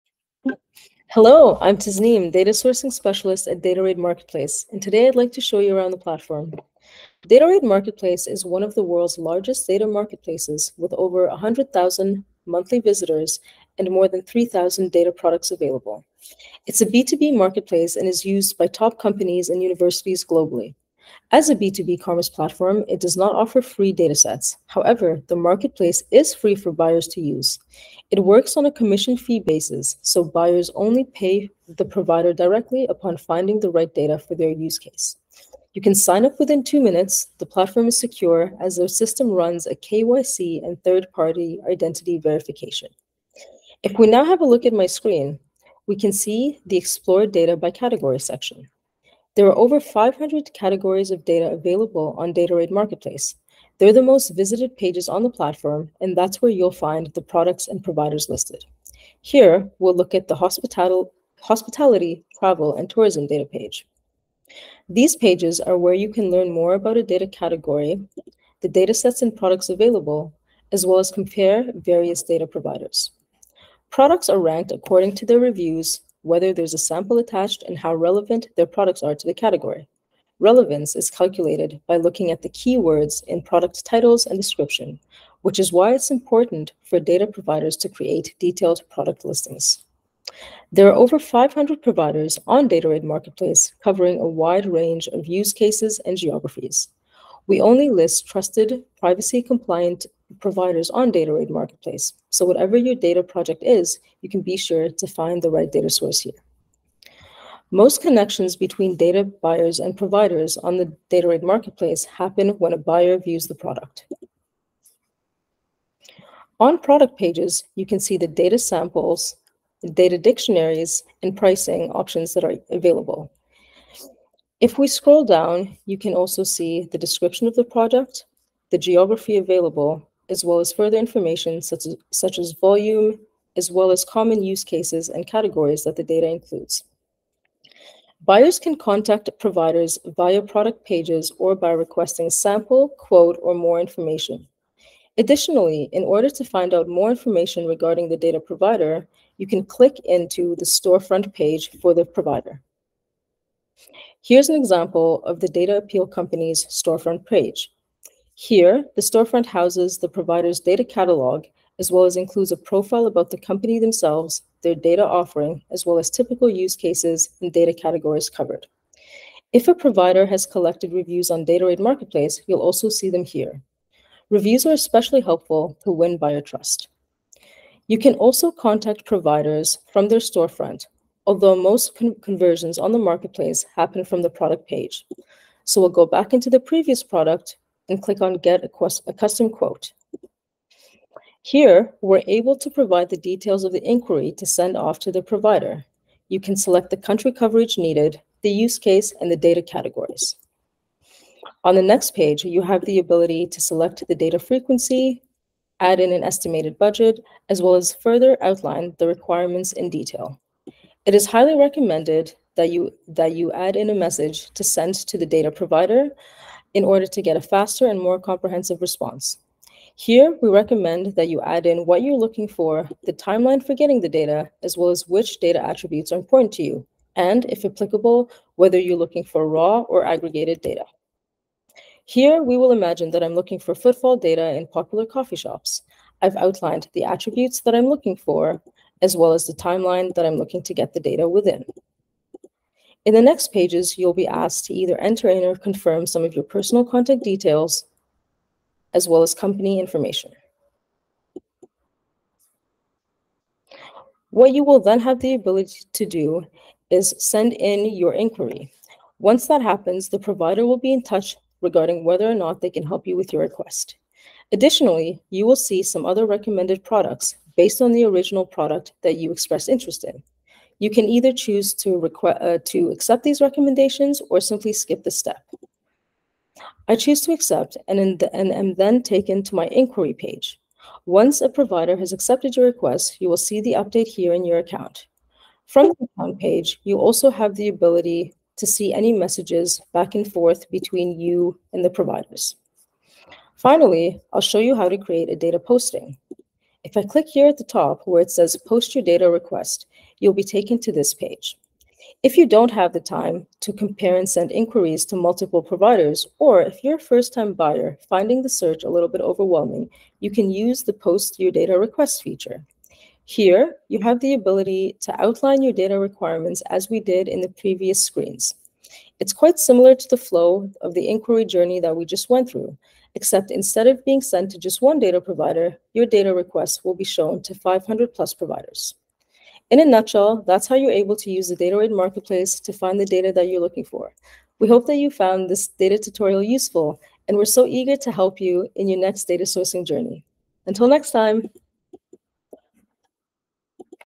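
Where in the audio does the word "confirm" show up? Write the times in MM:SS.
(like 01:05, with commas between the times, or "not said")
04:05.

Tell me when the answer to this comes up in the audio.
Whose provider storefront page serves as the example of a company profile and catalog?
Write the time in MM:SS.
02:35.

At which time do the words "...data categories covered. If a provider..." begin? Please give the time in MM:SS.
02:47.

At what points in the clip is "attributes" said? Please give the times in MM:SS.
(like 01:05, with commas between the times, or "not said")
03:45, 03:57.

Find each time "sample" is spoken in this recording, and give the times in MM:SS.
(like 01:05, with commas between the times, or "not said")
01:16, 01:58, 02:22.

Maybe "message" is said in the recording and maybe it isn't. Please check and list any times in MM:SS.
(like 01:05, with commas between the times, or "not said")
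03:33, 04:49.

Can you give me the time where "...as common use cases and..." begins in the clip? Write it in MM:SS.
02:13.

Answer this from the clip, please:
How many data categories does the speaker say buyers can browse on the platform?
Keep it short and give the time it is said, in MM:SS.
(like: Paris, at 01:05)
500, at 00:49.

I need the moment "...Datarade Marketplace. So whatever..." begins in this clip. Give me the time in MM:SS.
01:41.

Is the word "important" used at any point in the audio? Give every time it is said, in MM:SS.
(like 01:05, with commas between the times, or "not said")
01:26, 03:46.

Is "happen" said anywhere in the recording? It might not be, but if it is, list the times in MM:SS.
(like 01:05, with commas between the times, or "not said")
01:52, 03:03, 04:19.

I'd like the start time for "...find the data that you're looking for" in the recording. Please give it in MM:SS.
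05:32.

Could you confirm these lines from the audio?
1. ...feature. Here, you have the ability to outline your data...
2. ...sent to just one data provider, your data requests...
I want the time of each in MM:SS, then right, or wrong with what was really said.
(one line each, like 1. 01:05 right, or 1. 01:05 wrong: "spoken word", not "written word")
1. 05:12 right
2. 05:24 right.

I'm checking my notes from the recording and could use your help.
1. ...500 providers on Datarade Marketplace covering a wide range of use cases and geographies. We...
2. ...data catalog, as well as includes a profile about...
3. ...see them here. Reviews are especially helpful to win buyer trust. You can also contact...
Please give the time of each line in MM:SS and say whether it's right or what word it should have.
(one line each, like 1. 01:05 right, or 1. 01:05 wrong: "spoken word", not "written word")
1. 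01:31 right
2. 02:40 right
3. 02:52 right.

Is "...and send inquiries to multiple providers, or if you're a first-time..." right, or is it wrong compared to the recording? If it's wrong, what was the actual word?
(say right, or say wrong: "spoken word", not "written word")
right.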